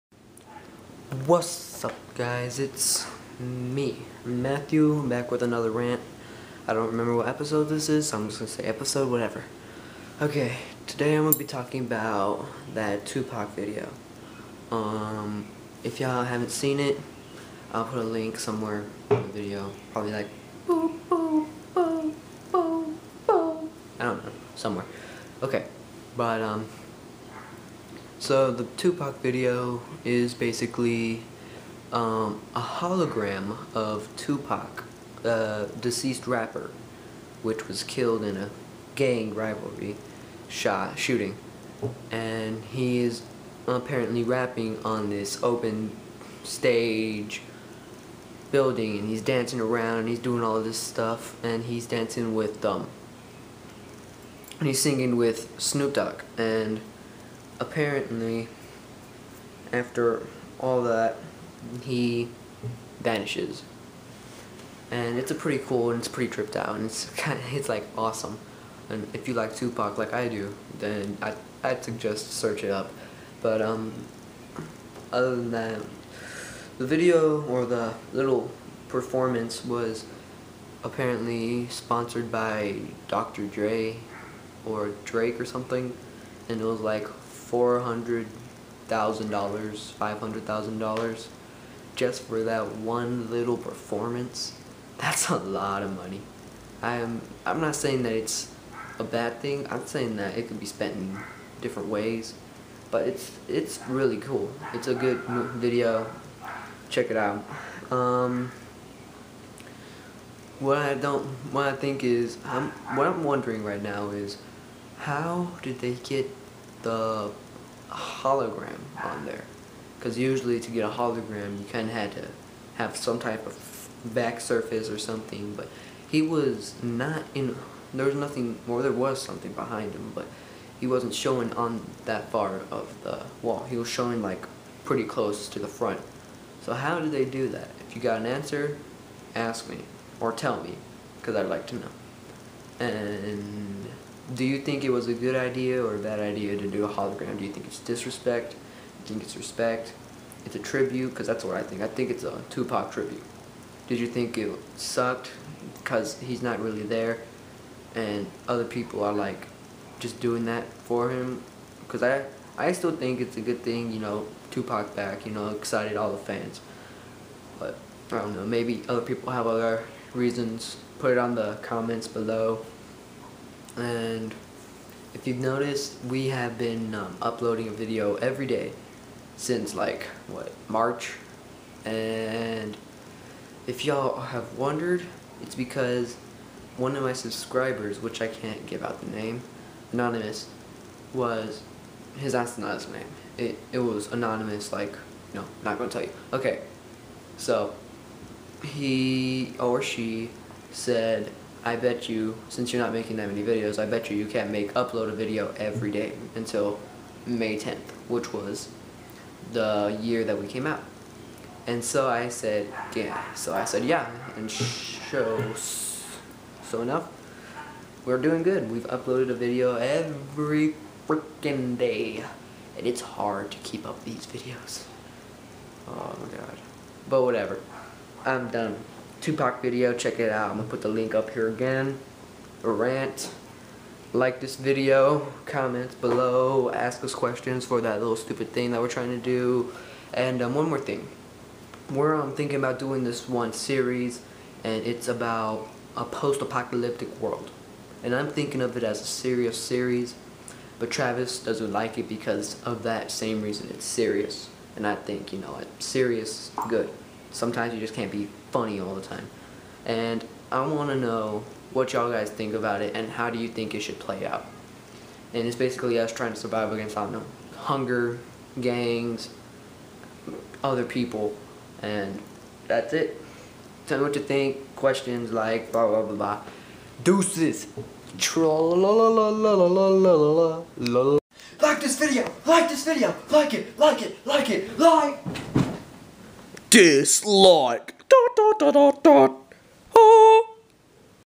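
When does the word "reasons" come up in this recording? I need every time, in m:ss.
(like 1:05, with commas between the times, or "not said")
2:50, 4:13.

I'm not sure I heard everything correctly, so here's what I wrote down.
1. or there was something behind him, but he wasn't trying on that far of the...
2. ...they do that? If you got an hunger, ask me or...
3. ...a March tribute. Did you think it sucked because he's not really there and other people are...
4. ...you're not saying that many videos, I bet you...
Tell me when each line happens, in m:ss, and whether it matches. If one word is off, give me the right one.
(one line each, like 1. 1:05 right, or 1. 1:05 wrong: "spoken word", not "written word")
1. 2:08 wrong: "showing", not "trying"
2. 2:17 wrong: "answer", not "hunger"
3. 2:32 wrong: "Tupac", not "March"
4. 3:22 wrong: "making", not "saying".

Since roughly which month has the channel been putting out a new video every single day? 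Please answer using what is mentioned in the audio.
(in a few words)
March.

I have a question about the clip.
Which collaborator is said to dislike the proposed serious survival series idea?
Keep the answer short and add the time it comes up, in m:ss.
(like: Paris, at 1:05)
Travis, at 4:10.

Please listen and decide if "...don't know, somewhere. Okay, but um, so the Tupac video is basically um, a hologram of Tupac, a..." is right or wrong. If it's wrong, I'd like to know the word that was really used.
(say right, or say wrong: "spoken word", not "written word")
right.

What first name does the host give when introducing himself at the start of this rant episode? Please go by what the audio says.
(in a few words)
Matthew.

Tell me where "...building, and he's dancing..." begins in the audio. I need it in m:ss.
0:48.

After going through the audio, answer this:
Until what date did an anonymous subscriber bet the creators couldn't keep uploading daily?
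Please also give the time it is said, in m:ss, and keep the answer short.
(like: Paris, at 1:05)
May 10th, at 3:27.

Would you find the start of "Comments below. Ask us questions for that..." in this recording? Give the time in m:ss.
3:55.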